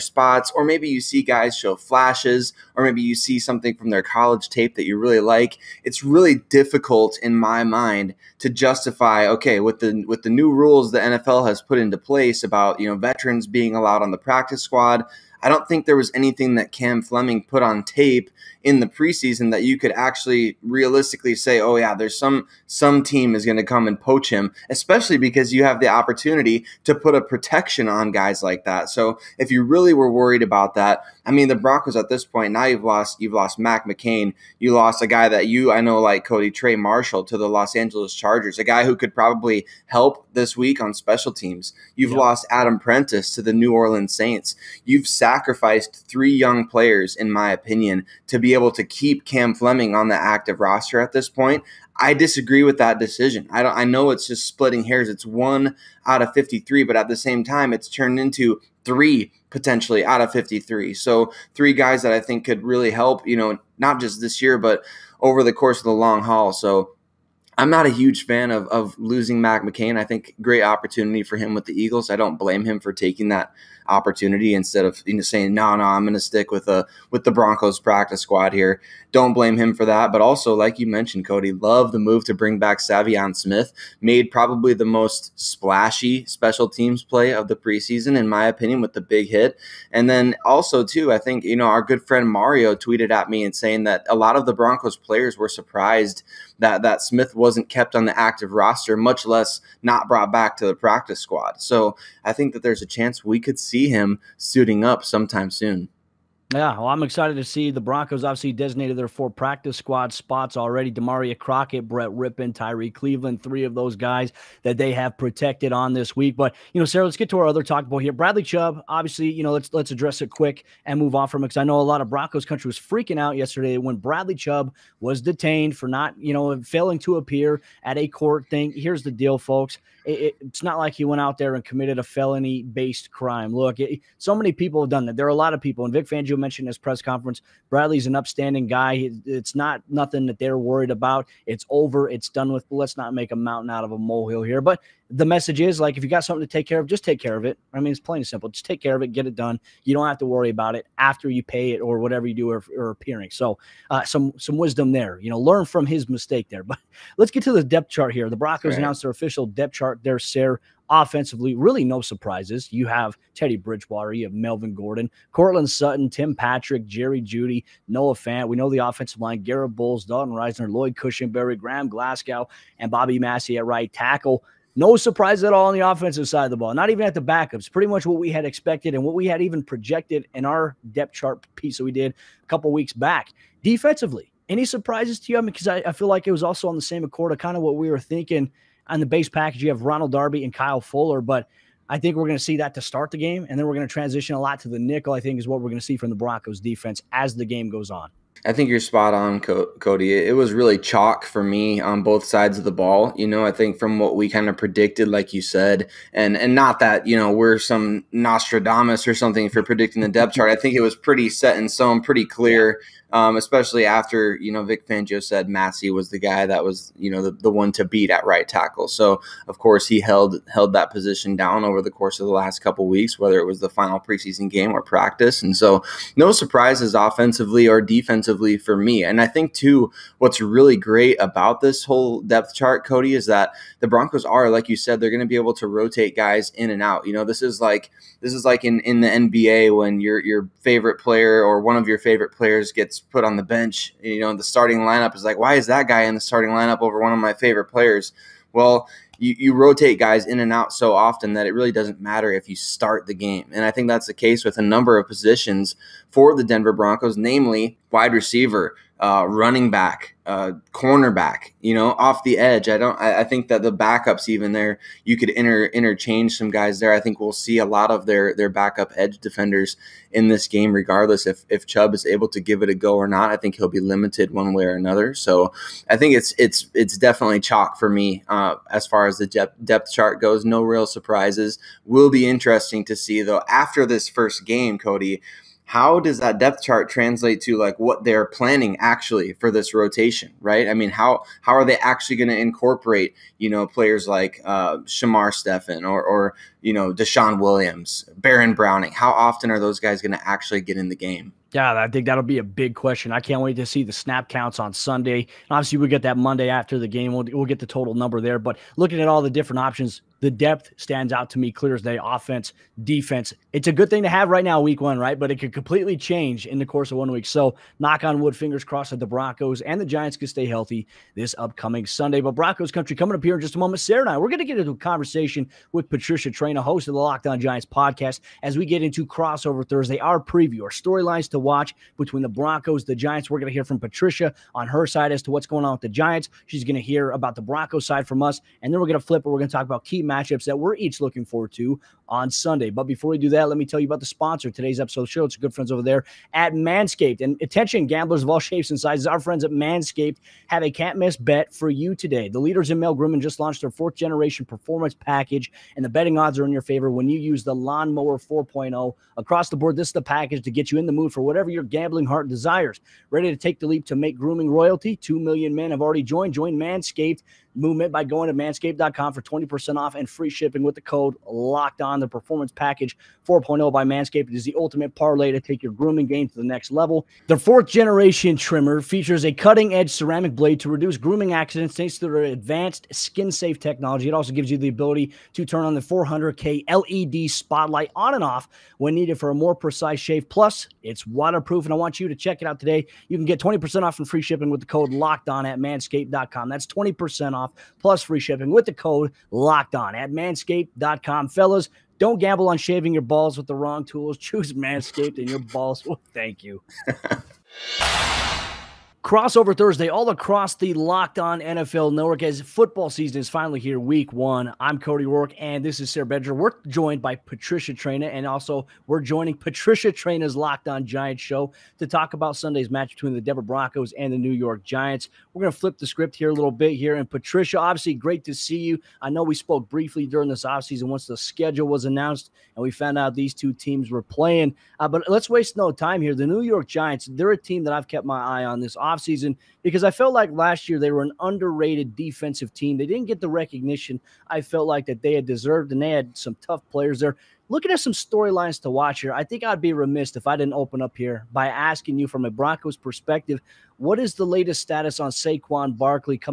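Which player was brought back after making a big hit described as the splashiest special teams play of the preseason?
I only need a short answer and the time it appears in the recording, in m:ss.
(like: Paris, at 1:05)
Savion Smith, at 1:22.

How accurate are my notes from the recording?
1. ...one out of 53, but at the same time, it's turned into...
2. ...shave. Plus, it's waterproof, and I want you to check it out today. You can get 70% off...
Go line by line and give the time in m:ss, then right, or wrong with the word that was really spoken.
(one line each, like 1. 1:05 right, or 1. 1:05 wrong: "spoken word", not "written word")
1. 0:55 right
2. 6:29 wrong: "20", not "70".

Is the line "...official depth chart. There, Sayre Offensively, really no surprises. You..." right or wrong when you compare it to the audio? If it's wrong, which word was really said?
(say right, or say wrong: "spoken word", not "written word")
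right.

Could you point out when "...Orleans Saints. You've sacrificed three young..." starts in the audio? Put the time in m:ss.
0:43.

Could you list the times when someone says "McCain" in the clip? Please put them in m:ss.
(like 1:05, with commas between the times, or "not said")
0:33, 1:09.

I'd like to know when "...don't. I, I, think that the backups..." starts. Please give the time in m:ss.
4:22.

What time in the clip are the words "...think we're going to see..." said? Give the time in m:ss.
3:11.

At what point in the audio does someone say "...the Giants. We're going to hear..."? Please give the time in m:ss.
5:32.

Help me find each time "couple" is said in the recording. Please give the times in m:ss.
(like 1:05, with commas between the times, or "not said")
3:02, 3:42.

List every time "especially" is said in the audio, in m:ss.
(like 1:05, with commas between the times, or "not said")
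0:24, 3:33.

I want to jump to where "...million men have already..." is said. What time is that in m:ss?
6:05.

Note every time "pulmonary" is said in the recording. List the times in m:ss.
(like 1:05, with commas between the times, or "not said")
not said.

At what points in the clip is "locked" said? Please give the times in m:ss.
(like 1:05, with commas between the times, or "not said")
5:26, 6:11, 6:34, 6:39, 6:50, 7:00.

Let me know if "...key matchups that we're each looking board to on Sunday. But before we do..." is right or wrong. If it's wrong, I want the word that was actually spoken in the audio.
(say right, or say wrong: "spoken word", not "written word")
wrong: "forward", not "board".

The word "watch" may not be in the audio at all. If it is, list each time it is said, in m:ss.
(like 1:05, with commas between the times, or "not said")
5:31, 7:28.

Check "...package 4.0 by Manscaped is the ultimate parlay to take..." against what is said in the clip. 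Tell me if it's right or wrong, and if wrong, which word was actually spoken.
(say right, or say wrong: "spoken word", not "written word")
right.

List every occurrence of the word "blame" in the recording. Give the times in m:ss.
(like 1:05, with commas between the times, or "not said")
1:12, 1:19.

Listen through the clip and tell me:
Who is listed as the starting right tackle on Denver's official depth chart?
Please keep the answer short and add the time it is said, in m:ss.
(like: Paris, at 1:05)
Bobby Massie, at 2:52.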